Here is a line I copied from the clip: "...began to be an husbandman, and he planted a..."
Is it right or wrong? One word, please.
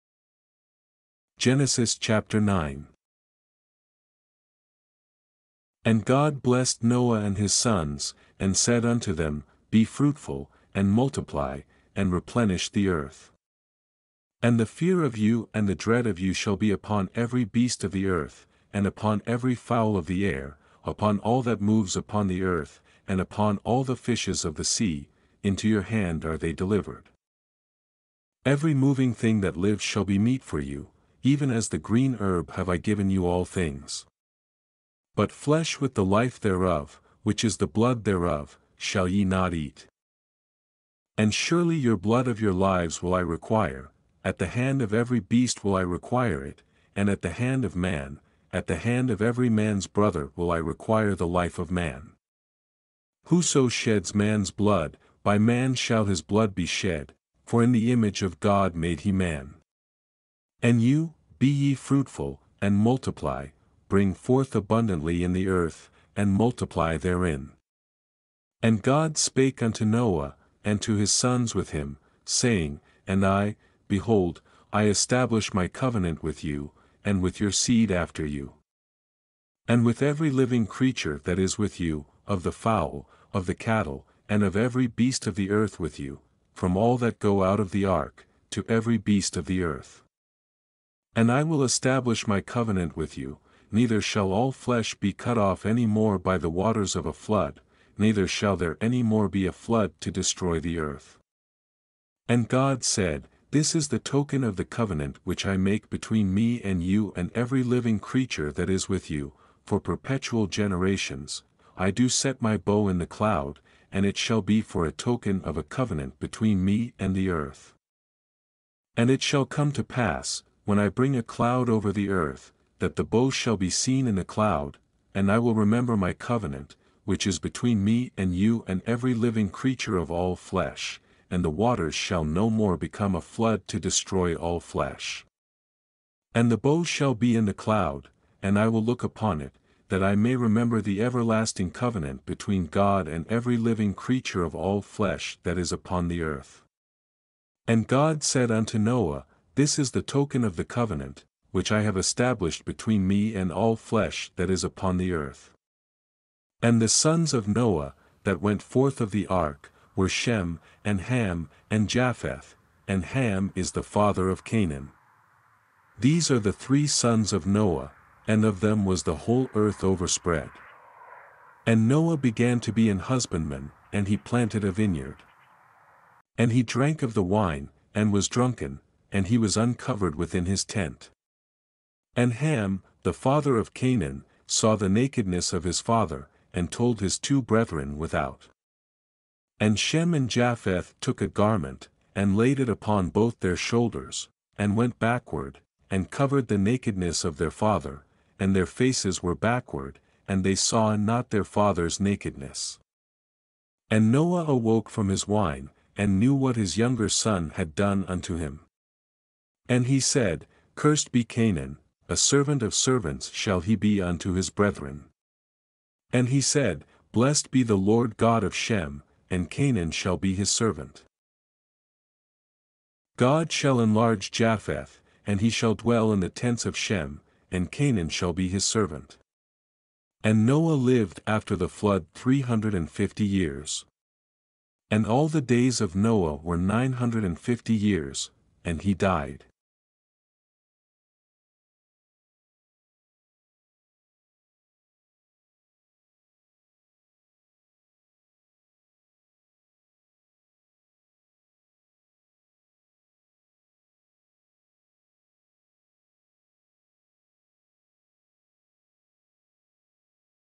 right.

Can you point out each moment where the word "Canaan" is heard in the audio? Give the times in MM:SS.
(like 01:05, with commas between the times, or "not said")
02:44, 03:03, 03:31, 03:39, 03:47.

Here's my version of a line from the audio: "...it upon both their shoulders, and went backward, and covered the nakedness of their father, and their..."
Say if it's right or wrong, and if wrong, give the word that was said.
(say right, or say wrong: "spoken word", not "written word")
right.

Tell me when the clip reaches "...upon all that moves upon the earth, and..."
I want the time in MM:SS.
00:20.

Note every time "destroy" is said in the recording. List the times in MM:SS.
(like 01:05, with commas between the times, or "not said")
01:40, 02:13.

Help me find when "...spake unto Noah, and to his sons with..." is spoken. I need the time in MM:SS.
01:09.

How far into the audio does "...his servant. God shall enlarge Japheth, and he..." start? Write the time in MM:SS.
03:40.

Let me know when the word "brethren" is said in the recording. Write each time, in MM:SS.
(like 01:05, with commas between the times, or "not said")
03:07, 03:34.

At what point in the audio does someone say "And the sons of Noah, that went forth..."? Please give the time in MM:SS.
02:36.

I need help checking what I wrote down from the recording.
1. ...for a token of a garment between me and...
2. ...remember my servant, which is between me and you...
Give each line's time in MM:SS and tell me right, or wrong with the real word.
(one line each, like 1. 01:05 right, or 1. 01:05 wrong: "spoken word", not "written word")
1. 01:54 wrong: "covenant", not "garment"
2. 02:05 wrong: "covenant", not "servant".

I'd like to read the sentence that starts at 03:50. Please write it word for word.
And Noah lived after the flood three hundred and fifty years.